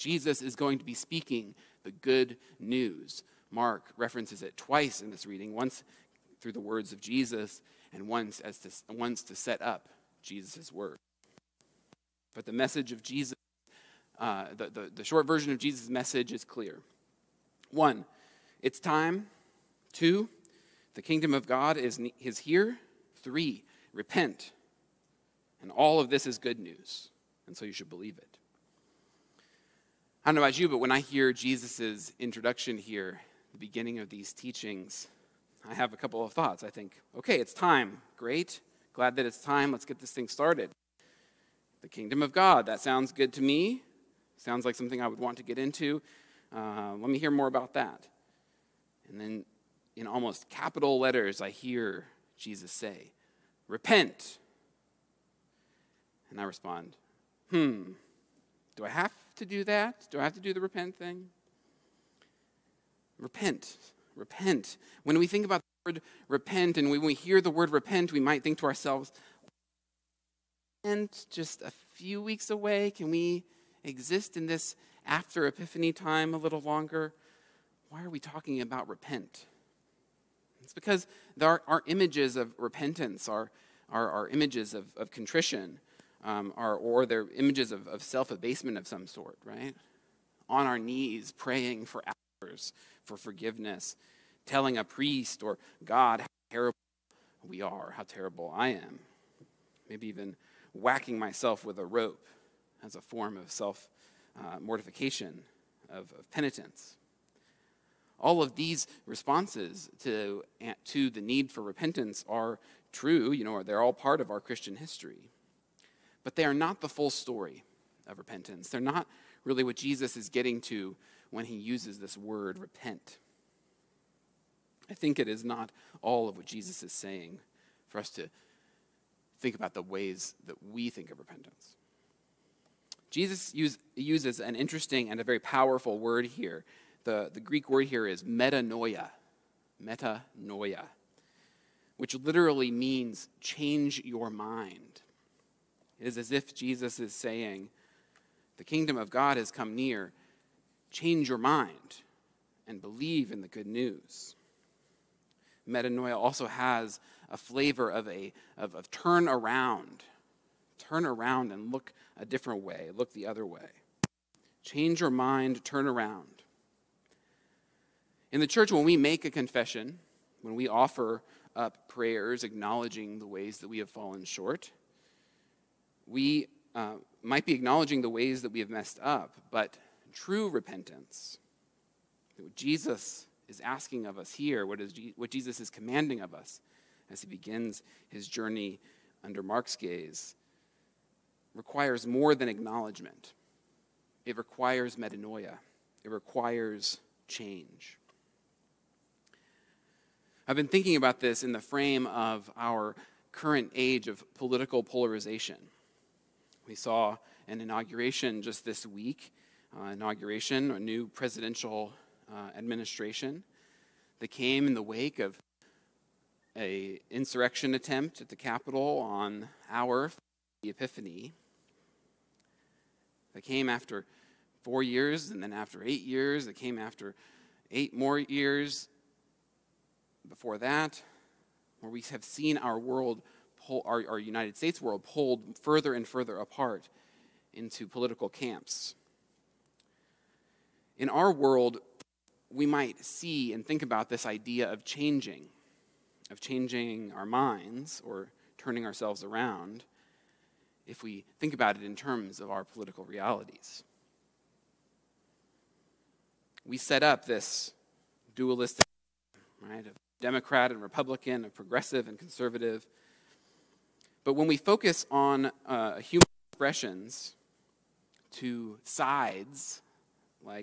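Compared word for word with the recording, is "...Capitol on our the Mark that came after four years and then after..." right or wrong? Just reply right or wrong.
wrong.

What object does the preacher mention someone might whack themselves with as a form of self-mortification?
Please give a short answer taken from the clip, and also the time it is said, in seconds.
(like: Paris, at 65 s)
a rope, at 101 s.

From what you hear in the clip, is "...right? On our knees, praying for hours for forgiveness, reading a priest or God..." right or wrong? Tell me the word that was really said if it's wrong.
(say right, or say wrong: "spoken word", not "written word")
wrong: "telling", not "reading".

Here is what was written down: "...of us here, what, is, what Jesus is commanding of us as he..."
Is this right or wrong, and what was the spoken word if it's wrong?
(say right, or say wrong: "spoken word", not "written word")
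right.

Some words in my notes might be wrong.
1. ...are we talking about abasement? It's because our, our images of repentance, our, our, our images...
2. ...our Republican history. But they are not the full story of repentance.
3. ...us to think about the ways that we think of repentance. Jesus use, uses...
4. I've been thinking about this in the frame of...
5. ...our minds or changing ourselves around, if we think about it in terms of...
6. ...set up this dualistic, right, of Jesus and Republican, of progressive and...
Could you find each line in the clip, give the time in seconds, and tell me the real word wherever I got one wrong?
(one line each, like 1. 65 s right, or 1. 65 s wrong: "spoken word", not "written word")
1. 78 s wrong: "repent", not "abasement"
2. 114 s wrong: "Christian", not "Republican"
3. 127 s right
4. 200 s right
5. 247 s wrong: "turning", not "changing"
6. 256 s wrong: "Democrat", not "Jesus".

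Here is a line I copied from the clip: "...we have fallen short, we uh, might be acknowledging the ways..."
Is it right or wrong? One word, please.
right.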